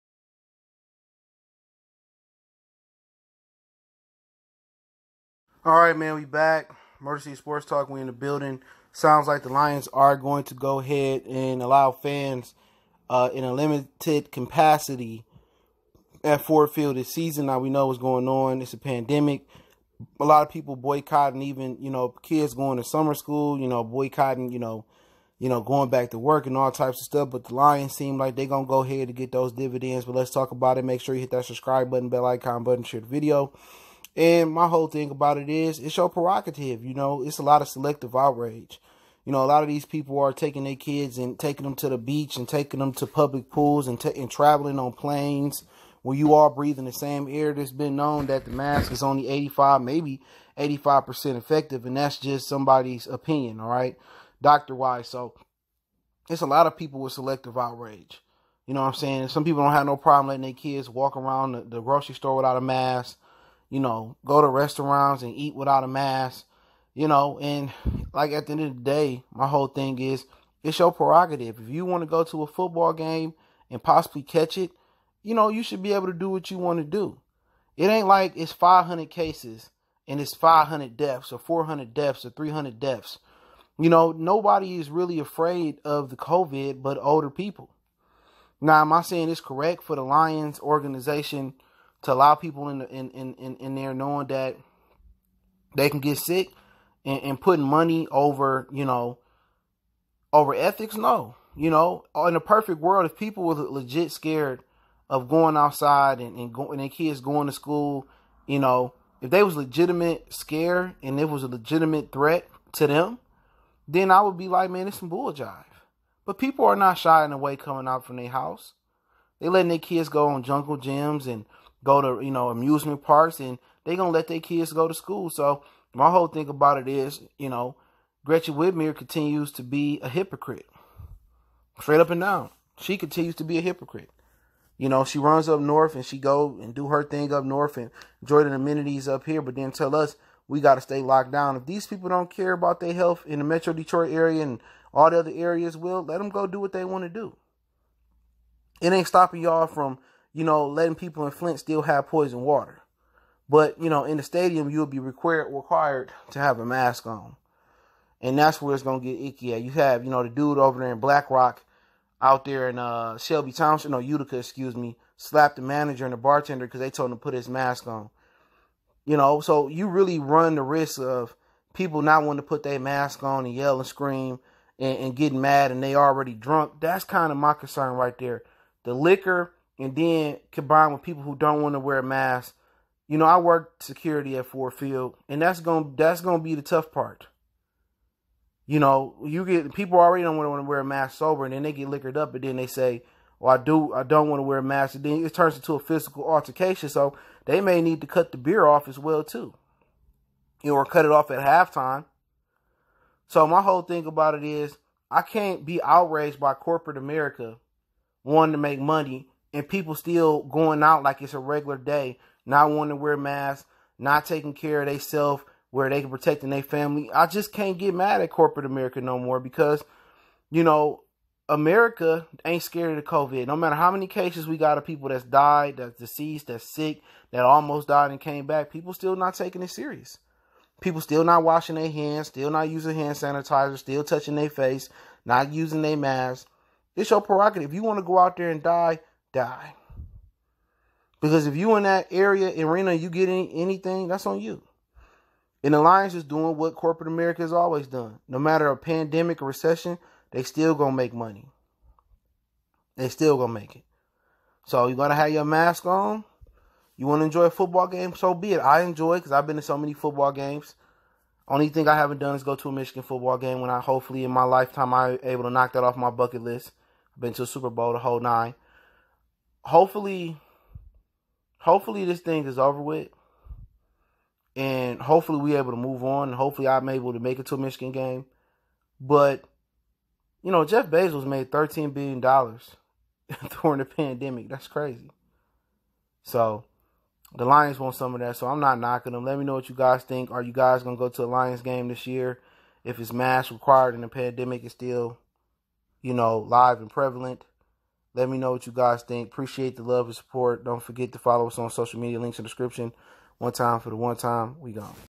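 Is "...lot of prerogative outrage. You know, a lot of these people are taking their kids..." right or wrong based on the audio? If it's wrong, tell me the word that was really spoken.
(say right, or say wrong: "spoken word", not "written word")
wrong: "selective", not "prerogative".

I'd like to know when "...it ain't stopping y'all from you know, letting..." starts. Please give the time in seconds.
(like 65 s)
148 s.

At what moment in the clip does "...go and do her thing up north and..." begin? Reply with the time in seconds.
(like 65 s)
136 s.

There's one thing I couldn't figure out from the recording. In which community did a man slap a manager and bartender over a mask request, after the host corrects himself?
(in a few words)
Utica.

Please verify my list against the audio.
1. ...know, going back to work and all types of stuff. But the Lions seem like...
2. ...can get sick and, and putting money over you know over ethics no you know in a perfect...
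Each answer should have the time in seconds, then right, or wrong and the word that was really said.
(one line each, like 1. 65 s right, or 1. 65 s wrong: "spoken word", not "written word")
1. 25 s right
2. 95 s right.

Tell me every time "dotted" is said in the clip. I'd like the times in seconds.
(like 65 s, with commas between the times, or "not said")
not said.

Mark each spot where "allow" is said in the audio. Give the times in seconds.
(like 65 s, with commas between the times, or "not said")
11 s, 92 s.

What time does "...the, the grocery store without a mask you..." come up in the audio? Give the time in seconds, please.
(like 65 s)
61 s.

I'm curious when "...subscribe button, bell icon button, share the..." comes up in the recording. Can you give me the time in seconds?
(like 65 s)
31 s.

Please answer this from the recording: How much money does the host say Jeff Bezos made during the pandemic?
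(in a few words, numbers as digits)
13 billion dollars.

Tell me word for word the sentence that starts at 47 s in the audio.
that has been known that the mask is only 85, maybe 85% effective, and that's just somebody's opinion, all right, doctor wise.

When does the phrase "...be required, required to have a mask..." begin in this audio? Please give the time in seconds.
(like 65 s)
154 s.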